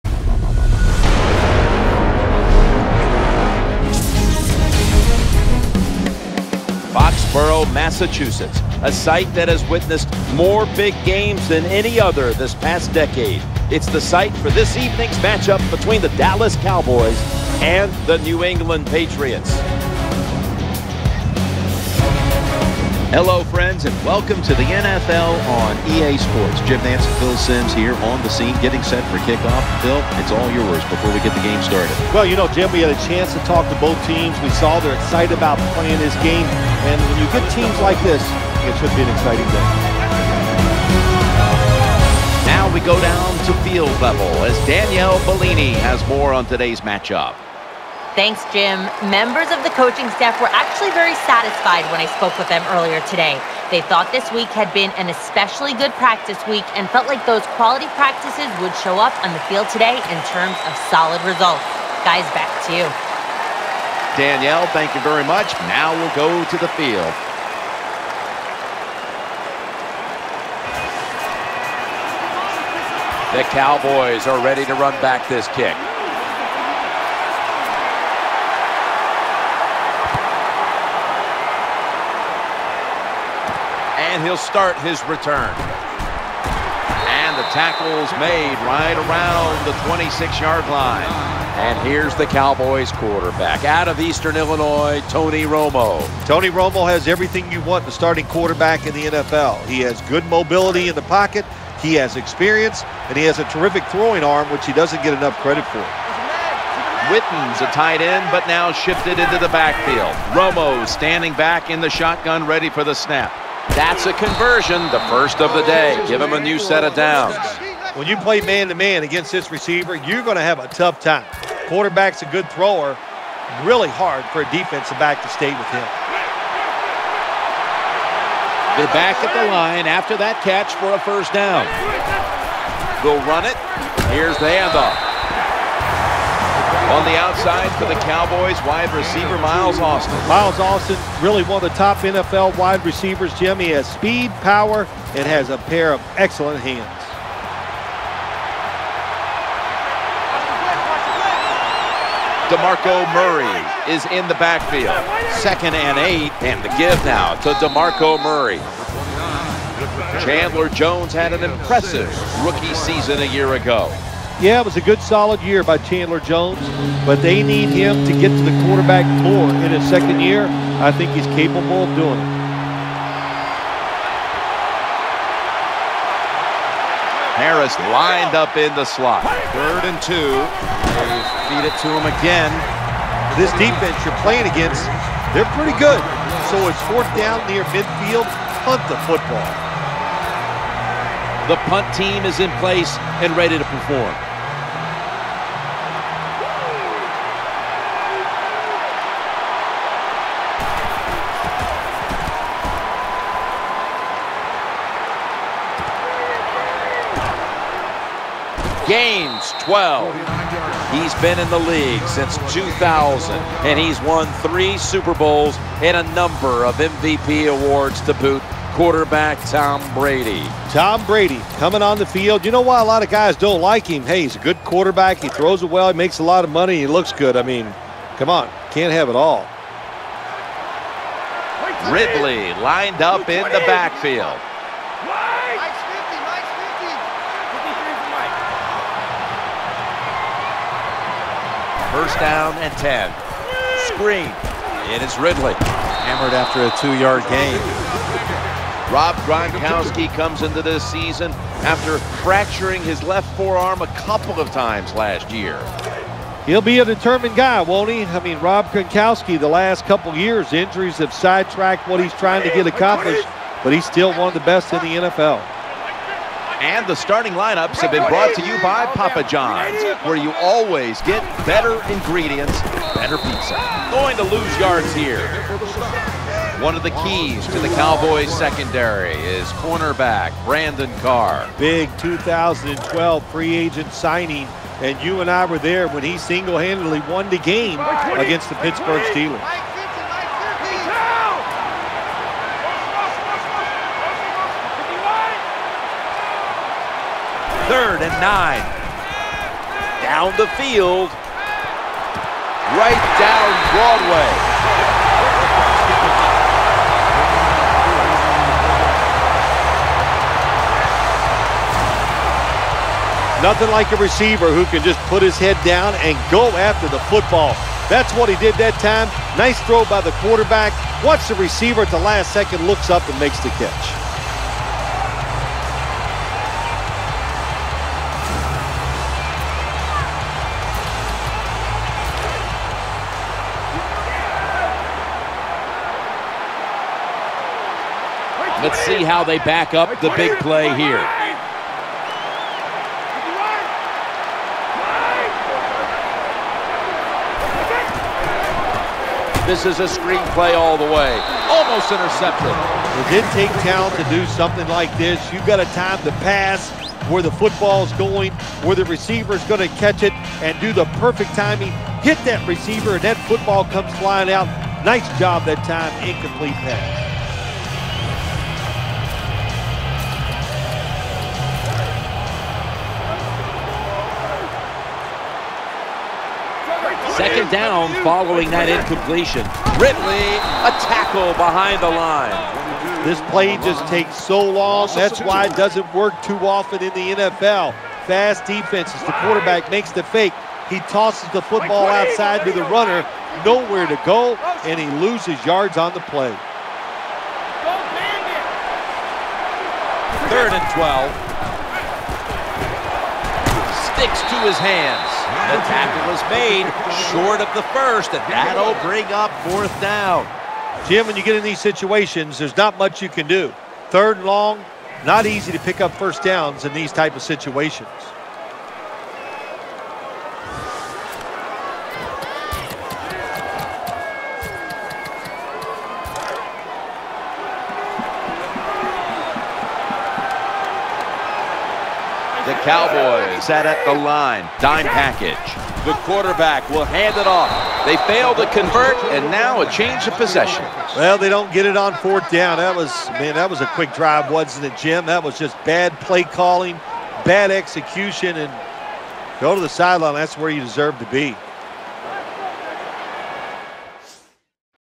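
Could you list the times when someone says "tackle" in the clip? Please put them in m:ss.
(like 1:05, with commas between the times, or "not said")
1:27, 6:20, 6:45.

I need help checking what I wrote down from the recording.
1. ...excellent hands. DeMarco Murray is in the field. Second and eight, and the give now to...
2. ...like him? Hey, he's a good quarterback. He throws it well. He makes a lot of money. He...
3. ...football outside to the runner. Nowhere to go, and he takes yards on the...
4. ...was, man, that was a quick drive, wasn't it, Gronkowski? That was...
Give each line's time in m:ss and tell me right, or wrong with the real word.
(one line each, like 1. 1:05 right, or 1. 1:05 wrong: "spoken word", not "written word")
1. 2:26 wrong: "backfield", not "field"
2. 3:43 right
3. 6:31 wrong: "loses", not "takes"
4. 7:22 wrong: "Jim", not "Gronkowski".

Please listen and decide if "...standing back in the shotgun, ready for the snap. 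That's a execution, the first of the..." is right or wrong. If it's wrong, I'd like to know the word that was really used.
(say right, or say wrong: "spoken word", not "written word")
wrong: "conversion", not "execution".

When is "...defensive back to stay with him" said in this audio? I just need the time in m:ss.
2:04.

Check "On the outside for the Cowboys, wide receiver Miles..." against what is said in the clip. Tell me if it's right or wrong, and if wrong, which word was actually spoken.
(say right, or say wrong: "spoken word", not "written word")
right.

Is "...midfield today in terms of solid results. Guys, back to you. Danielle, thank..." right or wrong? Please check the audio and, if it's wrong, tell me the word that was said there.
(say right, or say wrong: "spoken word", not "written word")
wrong: "field", not "midfield".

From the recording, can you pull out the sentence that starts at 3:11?
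The punt team is in place and ready to perform.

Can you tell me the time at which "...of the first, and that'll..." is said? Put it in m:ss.
6:47.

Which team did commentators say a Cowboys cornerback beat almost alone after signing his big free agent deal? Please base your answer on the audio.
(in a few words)
Pittsburgh Steelers.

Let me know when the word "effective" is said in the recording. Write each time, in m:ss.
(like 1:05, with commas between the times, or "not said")
not said.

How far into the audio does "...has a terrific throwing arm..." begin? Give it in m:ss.
1:43.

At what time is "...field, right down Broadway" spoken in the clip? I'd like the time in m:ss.
5:00.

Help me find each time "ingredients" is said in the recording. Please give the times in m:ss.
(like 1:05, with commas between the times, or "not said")
4:31.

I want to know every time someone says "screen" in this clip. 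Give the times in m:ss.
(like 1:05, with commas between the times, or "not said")
4:03, 5:49.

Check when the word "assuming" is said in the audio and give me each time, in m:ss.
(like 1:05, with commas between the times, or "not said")
not said.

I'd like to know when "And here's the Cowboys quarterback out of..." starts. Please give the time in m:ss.
1:31.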